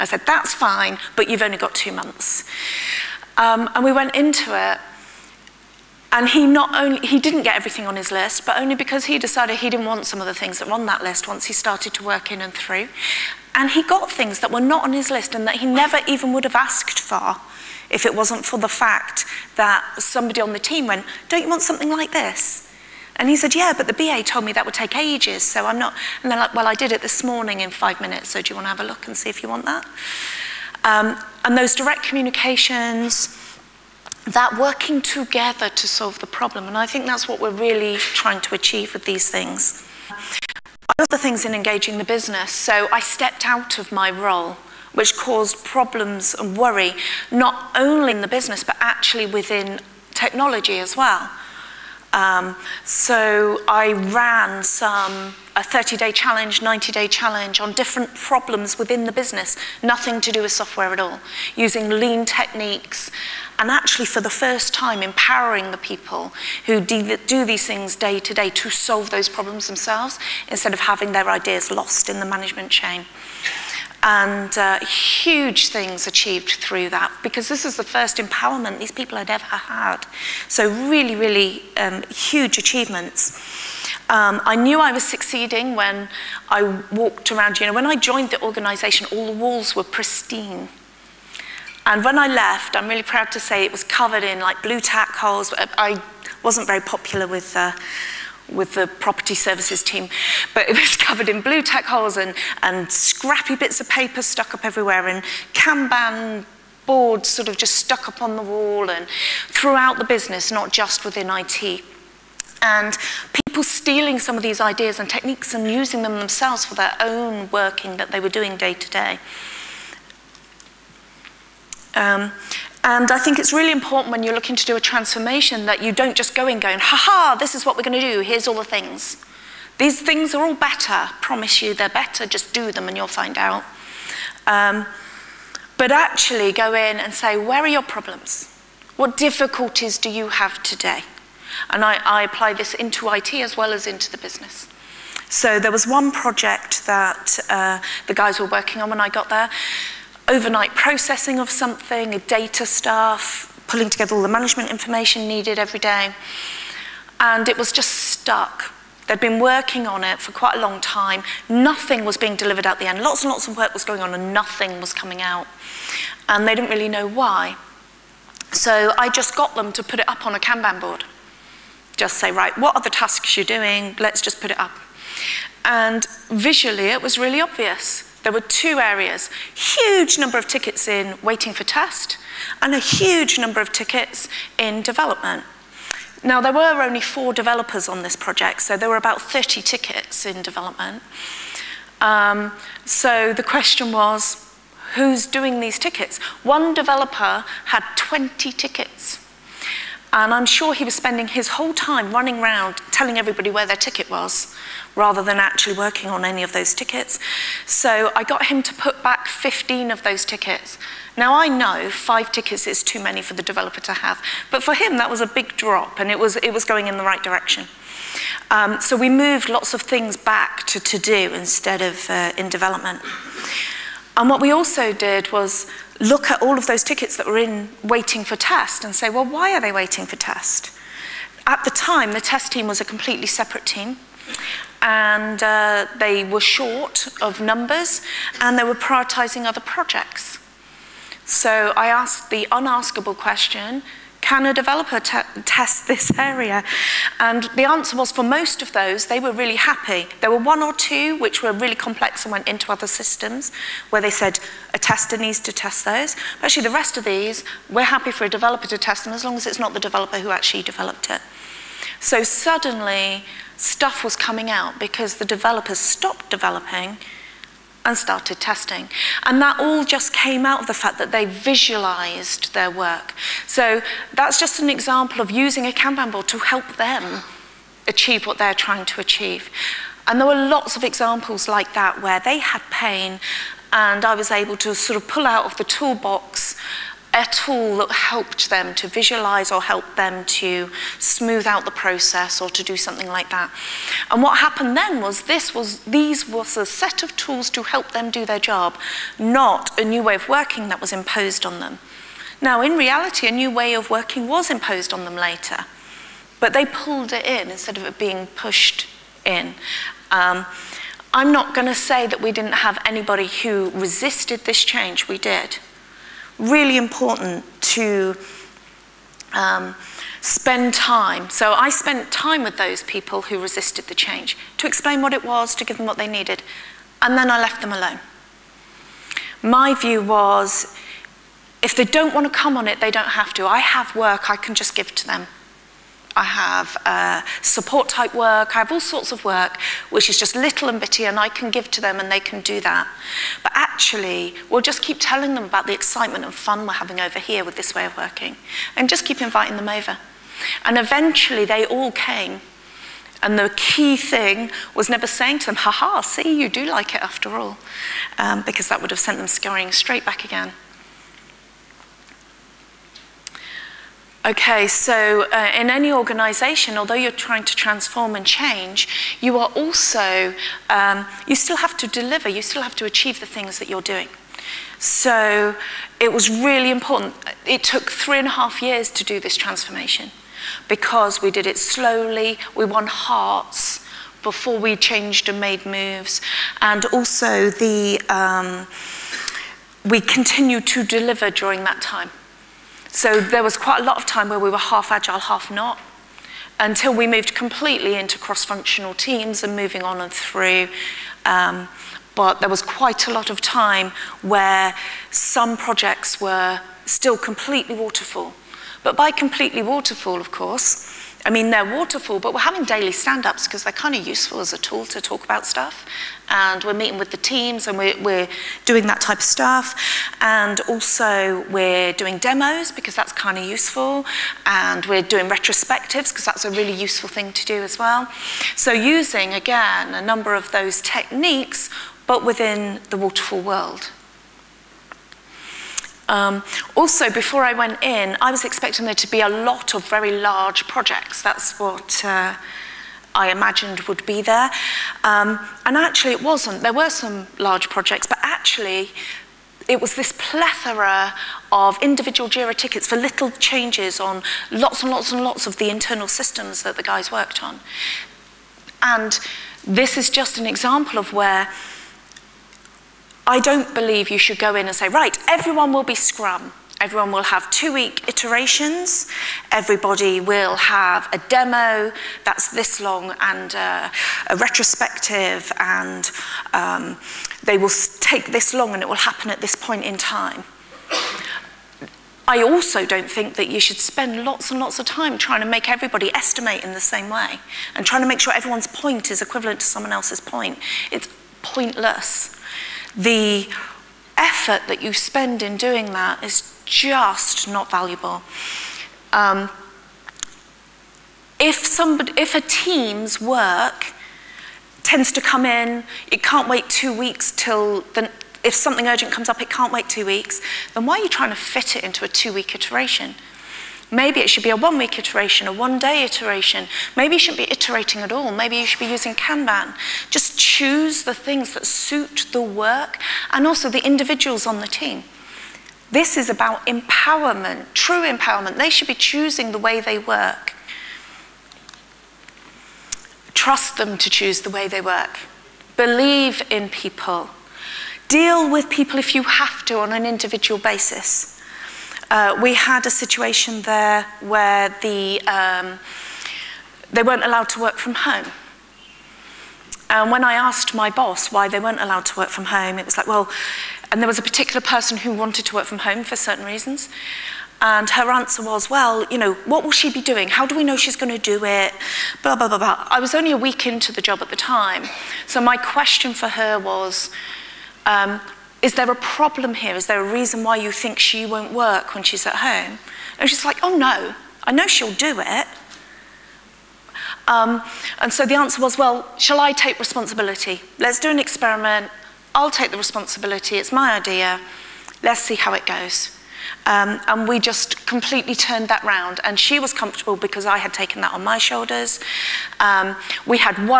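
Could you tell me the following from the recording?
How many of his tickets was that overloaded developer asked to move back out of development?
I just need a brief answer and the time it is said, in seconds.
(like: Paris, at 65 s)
15, at 209 s.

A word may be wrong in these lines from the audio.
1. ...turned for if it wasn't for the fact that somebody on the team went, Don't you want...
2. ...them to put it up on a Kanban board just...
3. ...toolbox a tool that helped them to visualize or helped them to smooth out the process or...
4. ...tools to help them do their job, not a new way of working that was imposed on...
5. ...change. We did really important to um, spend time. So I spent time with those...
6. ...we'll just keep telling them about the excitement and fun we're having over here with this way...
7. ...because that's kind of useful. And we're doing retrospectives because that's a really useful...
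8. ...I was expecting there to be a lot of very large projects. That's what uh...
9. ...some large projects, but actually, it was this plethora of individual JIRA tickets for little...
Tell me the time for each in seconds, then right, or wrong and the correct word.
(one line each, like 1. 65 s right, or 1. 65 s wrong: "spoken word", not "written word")
1. 16 s wrong: "asked", not "turned"
2. 169 s right
3. 285 s right
4. 297 s right
5. 314 s right
6. 344 s right
7. 422 s right
8. 438 s right
9. 446 s right.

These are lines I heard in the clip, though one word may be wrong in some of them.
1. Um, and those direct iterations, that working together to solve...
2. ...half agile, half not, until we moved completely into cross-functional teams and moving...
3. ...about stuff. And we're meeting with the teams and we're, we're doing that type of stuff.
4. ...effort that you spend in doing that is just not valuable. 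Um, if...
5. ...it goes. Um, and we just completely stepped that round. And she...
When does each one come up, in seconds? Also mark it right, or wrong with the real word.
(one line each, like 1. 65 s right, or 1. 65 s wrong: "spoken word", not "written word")
1. 30 s wrong: "communications", not "iterations"
2. 394 s right
3. 415 s right
4. 494 s right
5. 585 s wrong: "turned", not "stepped".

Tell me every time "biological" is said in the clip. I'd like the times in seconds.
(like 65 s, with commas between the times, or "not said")
not said.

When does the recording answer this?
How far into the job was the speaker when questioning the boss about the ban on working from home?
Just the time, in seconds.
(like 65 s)
563 s.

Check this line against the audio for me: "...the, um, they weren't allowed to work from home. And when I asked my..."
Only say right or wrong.
right.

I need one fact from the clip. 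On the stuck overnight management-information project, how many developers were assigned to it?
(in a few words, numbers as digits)
4.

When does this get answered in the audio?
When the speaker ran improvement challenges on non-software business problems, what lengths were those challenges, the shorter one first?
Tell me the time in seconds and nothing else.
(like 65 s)
55 s.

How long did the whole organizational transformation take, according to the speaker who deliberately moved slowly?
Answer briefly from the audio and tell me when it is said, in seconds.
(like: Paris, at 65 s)
3.5 years, at 377 s.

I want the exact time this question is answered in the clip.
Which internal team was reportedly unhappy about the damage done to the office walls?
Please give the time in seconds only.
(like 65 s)
98 s.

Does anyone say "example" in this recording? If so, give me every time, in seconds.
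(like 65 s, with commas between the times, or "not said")
274 s, 280 s, 460 s.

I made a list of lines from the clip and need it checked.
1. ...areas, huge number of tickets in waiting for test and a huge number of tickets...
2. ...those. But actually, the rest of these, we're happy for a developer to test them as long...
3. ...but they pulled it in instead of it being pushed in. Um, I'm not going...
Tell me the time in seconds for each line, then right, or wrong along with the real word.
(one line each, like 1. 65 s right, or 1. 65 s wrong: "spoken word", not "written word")
1. 178 s right
2. 255 s right
3. 306 s right.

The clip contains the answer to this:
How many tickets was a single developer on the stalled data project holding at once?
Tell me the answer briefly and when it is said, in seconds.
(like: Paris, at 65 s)
20, at 197 s.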